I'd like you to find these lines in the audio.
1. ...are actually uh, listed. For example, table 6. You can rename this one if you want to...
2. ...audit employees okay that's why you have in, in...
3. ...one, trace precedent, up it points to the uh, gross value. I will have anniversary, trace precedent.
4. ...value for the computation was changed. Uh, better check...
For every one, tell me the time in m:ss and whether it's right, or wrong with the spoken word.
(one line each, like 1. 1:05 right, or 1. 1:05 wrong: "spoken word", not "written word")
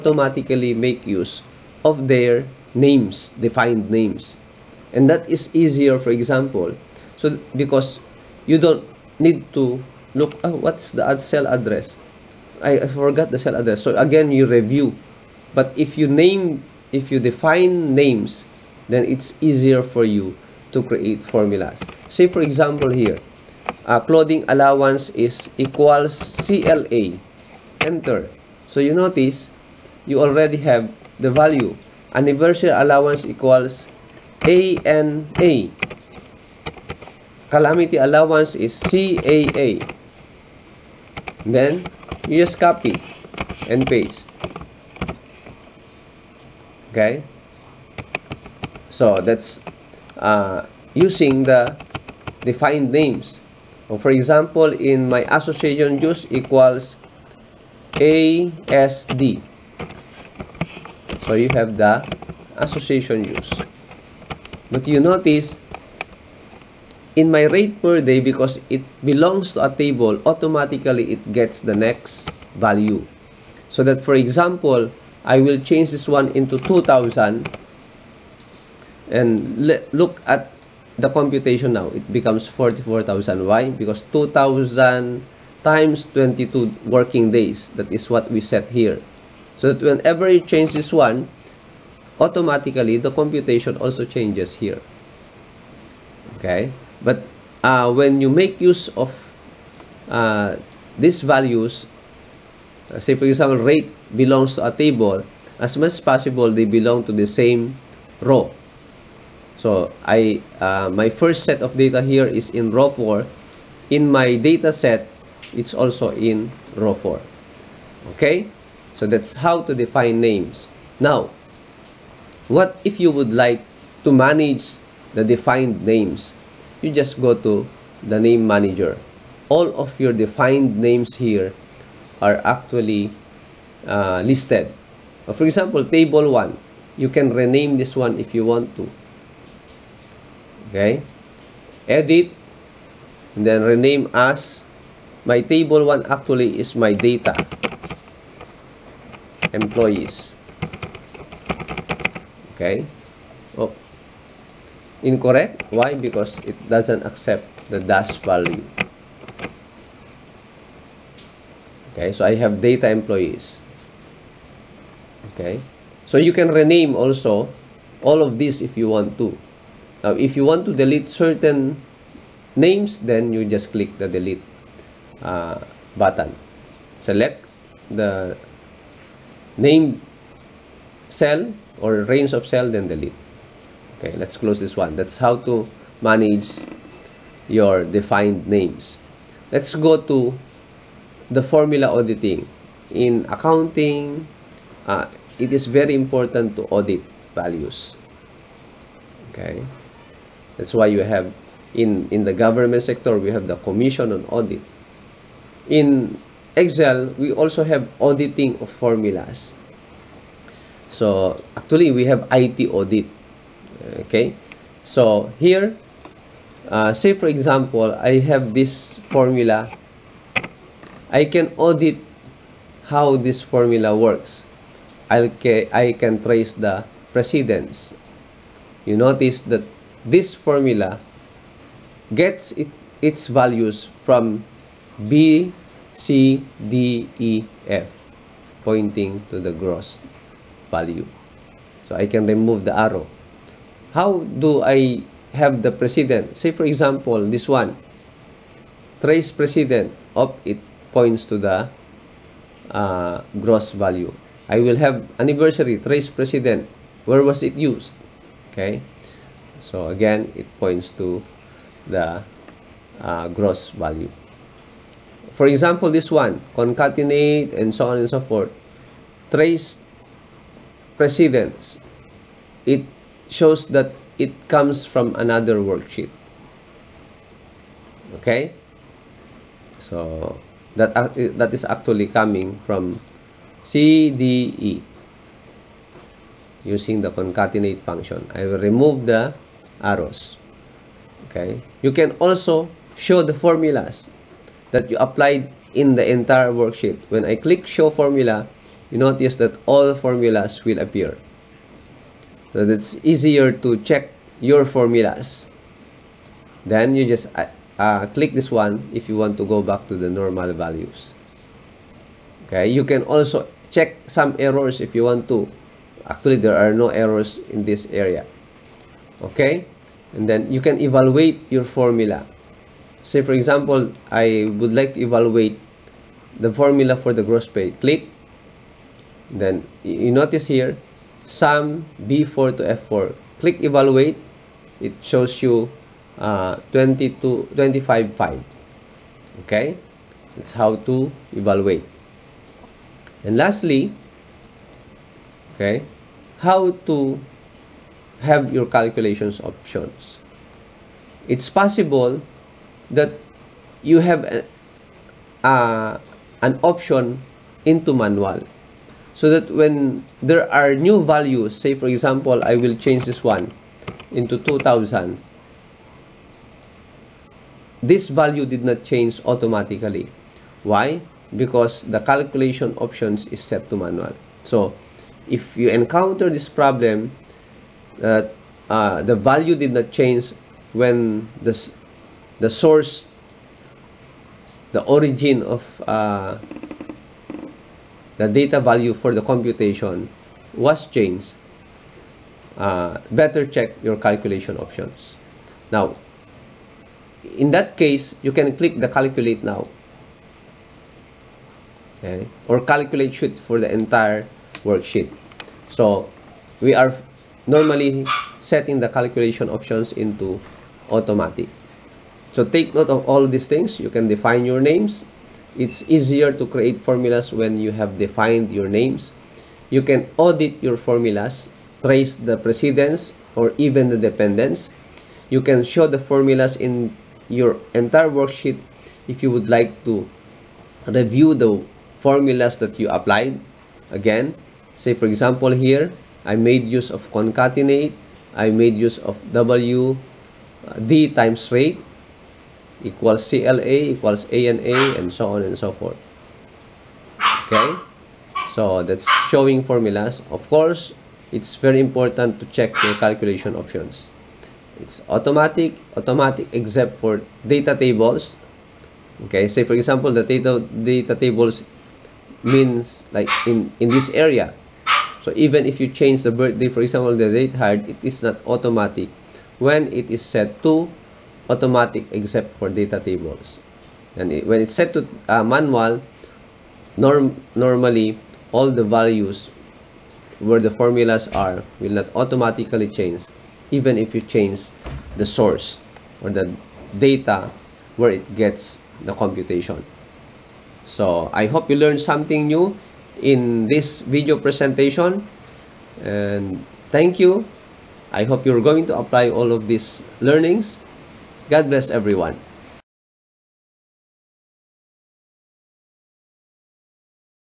1. 2:12 wrong: "1", not "6"
2. 3:16 wrong: "values", not "employees"
3. 4:07 right
4. 6:28 right.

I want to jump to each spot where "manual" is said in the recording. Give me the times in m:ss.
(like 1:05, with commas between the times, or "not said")
5:57, 6:13, 7:55.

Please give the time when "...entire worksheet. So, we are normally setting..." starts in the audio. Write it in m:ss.
6:43.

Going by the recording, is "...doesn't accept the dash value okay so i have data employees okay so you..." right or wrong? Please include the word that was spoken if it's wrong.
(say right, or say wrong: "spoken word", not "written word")
right.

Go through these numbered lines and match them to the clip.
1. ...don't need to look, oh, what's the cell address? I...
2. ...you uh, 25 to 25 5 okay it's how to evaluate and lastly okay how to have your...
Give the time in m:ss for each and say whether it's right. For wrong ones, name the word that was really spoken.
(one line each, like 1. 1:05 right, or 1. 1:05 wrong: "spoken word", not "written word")
1. 0:08 right
2. 5:35 wrong: "20", not "25".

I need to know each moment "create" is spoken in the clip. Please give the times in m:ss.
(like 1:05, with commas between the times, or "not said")
0:20, 6:56.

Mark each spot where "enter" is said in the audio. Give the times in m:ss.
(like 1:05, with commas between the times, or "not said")
0:27.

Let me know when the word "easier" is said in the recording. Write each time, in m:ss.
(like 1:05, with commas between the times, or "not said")
0:05, 0:19, 5:03, 6:55.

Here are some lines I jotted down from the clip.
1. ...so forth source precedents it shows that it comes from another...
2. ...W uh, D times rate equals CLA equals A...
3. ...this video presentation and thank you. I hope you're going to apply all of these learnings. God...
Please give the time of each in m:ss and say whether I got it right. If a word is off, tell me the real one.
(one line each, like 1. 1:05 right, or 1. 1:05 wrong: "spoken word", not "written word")
1. 4:28 wrong: "trace", not "source"
2. 7:19 right
3. 8:13 right.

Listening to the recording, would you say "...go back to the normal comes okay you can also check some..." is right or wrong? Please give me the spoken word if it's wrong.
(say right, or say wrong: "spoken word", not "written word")
wrong: "values", not "comes".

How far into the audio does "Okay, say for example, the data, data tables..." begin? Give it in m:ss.
7:39.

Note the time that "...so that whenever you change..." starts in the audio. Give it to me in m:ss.
1:29.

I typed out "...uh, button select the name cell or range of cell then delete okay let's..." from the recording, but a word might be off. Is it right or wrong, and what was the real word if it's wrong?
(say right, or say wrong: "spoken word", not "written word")
right.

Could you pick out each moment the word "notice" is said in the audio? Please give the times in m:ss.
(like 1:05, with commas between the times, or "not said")
0:28, 1:05, 3:48, 4:58, 5:30.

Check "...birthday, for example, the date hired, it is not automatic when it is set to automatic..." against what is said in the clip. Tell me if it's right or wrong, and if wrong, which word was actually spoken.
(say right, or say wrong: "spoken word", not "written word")
right.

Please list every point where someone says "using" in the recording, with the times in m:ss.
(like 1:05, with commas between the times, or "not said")
0:50, 4:46.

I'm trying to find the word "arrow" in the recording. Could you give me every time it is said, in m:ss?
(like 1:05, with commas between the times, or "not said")
4:02, 4:49.